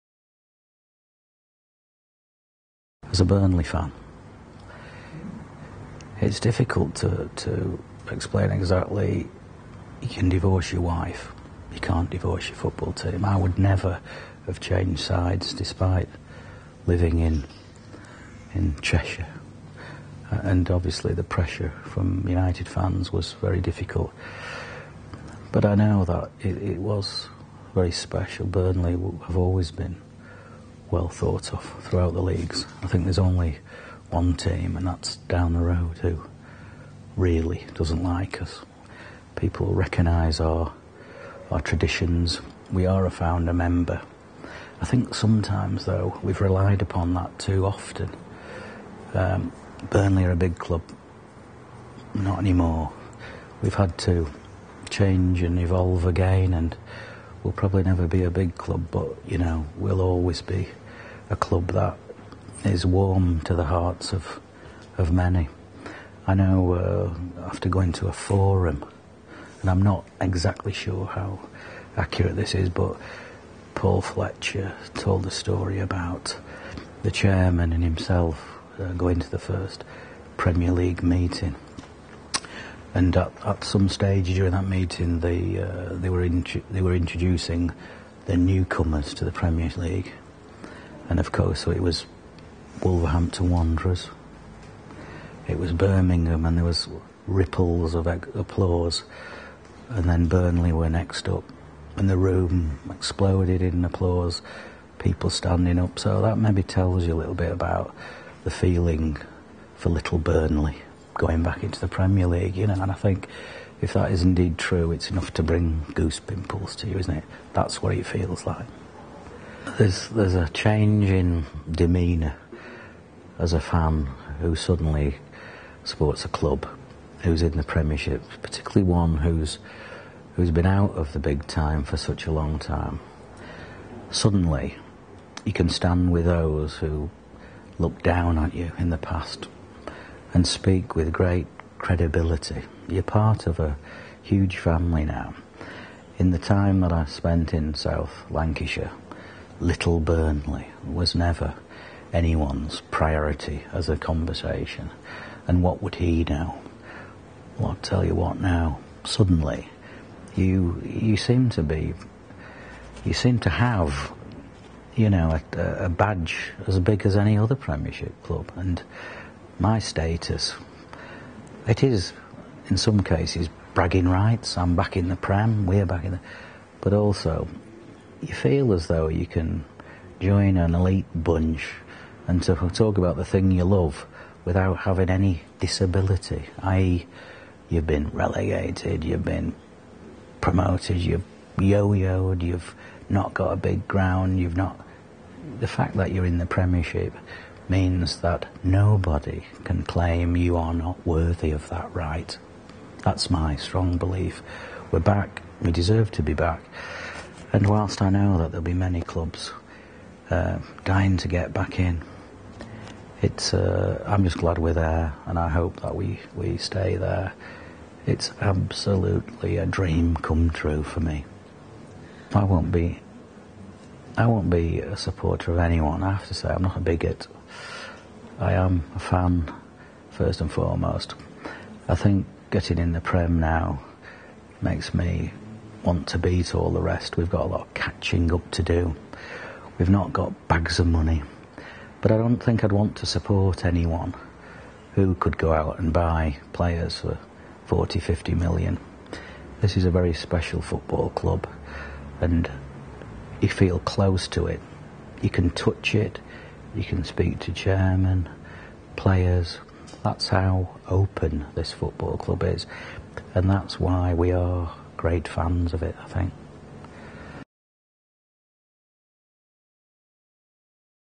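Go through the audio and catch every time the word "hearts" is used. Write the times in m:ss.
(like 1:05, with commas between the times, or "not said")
1:03.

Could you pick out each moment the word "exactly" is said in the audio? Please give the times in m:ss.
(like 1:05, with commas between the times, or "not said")
0:08, 1:10.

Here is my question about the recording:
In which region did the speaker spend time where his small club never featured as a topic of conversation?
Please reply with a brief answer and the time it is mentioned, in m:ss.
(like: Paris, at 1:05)
South Lancashire, at 2:27.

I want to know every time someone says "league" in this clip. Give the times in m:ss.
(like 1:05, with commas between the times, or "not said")
0:32, 1:20, 1:29, 1:52.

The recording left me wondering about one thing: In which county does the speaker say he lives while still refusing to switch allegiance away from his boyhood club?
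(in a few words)
Cheshire.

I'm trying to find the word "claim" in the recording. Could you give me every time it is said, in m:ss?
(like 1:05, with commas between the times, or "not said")
3:19.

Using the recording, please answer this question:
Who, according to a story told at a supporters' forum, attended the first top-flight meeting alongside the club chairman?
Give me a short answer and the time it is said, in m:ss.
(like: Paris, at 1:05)
Paul Fletcher, at 1:13.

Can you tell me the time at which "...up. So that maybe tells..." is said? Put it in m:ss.
1:45.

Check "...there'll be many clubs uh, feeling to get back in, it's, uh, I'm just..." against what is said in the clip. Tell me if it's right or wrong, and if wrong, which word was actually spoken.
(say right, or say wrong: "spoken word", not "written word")
wrong: "dying", not "feeling".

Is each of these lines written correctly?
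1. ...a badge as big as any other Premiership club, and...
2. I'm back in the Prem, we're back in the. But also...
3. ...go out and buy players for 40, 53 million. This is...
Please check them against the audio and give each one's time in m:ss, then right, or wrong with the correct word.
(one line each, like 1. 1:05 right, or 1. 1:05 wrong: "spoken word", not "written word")
1. 2:45 right
2. 2:54 right
3. 4:05 wrong: "50", not "53".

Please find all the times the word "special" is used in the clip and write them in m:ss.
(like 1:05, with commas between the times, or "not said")
0:27, 4:10.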